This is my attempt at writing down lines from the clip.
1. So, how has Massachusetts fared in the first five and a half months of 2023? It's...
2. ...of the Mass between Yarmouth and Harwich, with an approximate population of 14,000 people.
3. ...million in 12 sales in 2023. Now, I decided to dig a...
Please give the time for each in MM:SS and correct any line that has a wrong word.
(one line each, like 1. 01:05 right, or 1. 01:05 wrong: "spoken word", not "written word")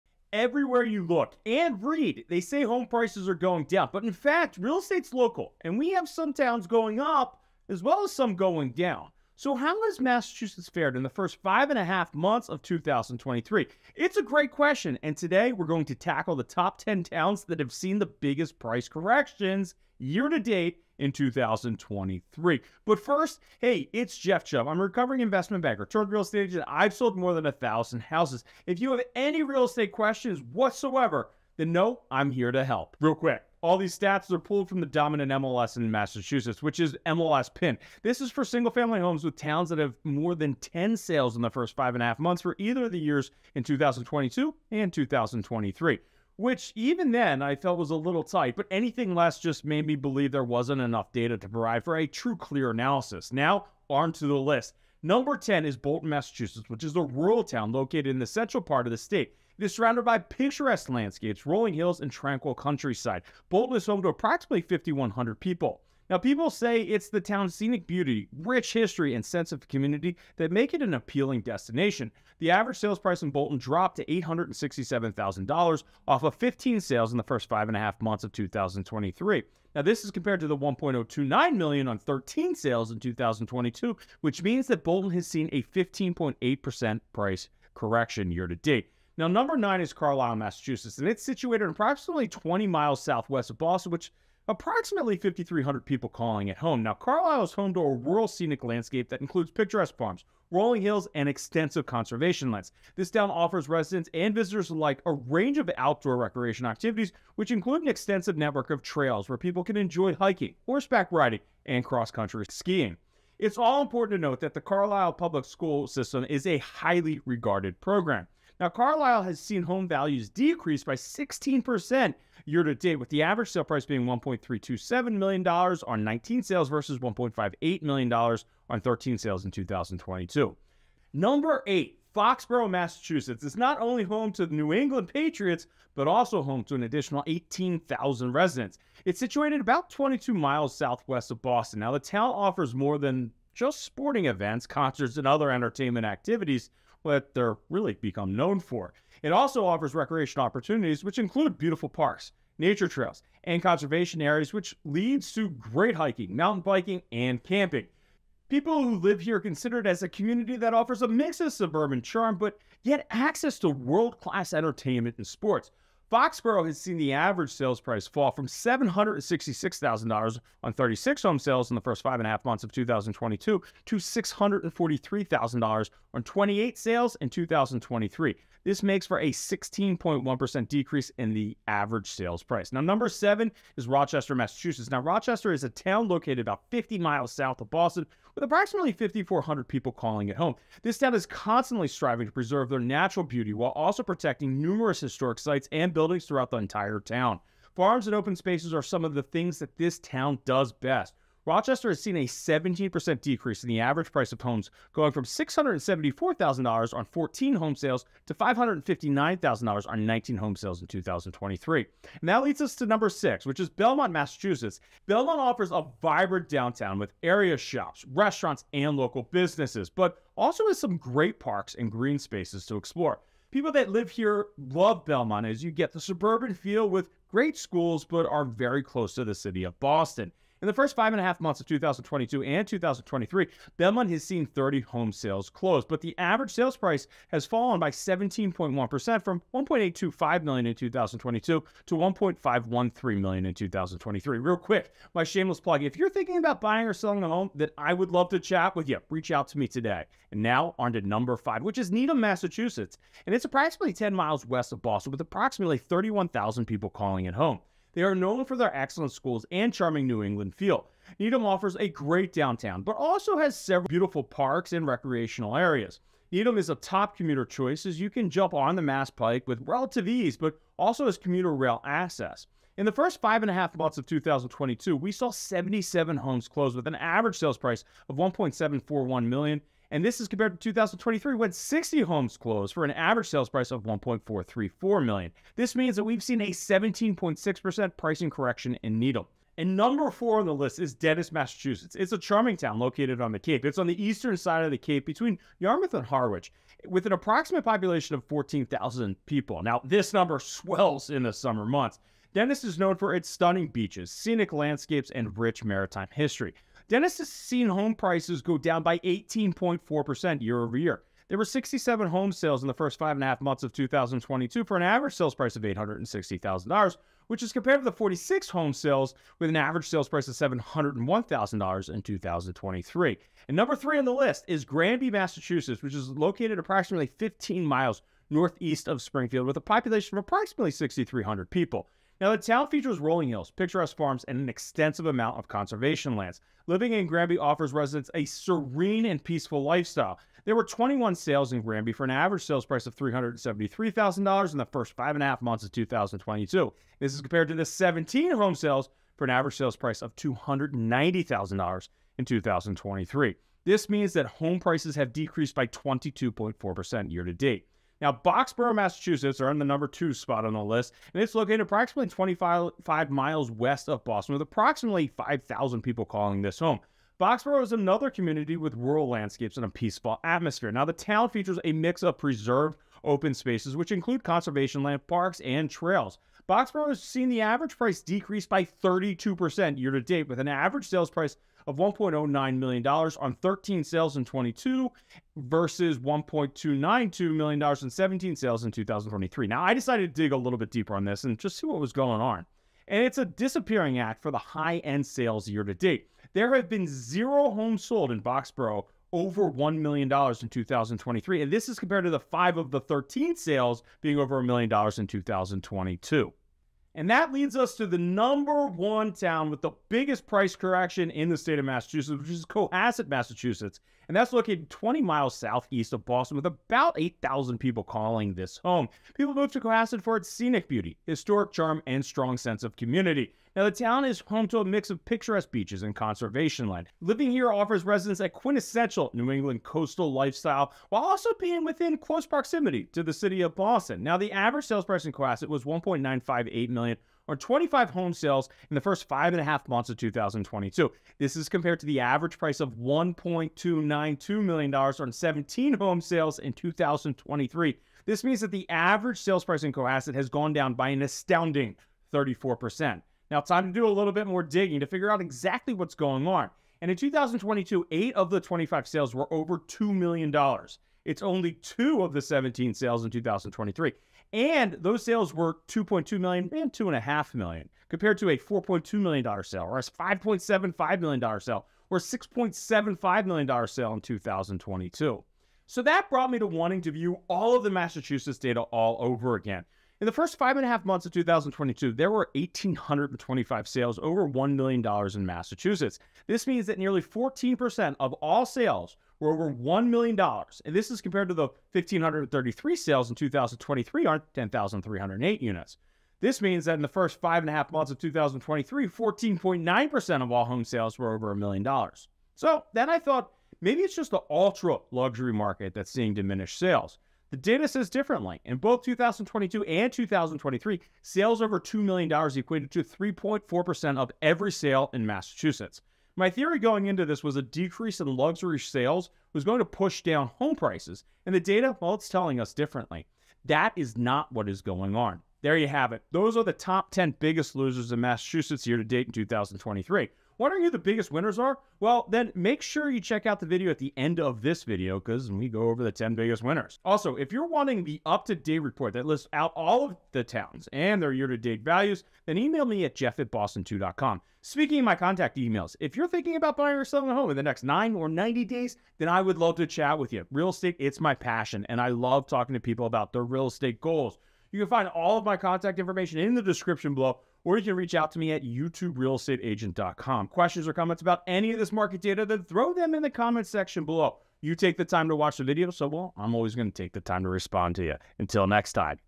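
1. 00:09 right
2. 04:54 wrong: "Cape", not "Mass"
3. 06:27 wrong: "17", not "12".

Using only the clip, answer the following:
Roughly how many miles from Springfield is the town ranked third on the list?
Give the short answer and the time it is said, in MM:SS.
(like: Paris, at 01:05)
15 miles, at 05:27.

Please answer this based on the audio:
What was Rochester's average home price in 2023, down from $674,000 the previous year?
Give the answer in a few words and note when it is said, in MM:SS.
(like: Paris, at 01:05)
$559,000, at 03:28.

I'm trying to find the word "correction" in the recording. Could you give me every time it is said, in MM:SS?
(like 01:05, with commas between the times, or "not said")
00:18, 01:27, 04:48, 06:50.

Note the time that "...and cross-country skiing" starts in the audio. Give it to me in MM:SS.
01:51.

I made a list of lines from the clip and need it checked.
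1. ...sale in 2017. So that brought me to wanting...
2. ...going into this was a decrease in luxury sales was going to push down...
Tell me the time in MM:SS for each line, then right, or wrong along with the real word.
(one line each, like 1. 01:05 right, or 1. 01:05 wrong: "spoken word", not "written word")
1. 07:53 wrong: "2022", not "2017"
2. 08:36 right.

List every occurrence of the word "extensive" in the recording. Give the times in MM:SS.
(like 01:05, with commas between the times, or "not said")
01:41, 01:47, 05:34.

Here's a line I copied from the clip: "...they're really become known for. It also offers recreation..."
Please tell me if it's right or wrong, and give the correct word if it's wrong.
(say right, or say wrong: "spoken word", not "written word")
right.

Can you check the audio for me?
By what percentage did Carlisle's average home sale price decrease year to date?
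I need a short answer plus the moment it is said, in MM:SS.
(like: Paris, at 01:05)
16%, at 02:00.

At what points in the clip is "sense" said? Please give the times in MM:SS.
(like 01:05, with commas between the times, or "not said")
01:09, 07:02.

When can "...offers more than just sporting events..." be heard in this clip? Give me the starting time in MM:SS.
02:22.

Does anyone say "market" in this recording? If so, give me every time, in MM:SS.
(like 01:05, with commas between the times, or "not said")
08:25, 09:21.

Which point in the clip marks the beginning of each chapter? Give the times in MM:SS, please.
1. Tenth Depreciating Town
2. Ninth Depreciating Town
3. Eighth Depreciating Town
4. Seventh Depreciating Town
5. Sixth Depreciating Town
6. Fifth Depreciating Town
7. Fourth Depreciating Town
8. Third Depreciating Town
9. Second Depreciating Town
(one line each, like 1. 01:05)
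1. 00:54
2. 01:28
3. 02:10
4. 03:02
5. 03:31
6. 04:09
7. 04:49
8. 05:22
9. 05:57.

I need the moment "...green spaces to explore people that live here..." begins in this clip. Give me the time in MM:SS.
03:41.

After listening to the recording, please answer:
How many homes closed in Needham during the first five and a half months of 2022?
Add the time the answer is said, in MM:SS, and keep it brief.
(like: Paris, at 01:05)
77, at 04:35.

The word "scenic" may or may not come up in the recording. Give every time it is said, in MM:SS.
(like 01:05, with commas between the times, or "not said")
01:07, 01:38, 05:04, 07:00.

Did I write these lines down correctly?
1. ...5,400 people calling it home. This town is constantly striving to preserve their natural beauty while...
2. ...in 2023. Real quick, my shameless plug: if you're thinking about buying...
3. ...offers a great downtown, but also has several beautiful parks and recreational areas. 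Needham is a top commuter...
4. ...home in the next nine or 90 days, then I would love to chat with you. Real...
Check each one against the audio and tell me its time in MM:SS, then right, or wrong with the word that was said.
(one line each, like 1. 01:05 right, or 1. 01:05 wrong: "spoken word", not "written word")
1. 03:08 right
2. 04:03 right
3. 04:21 right
4. 09:07 right.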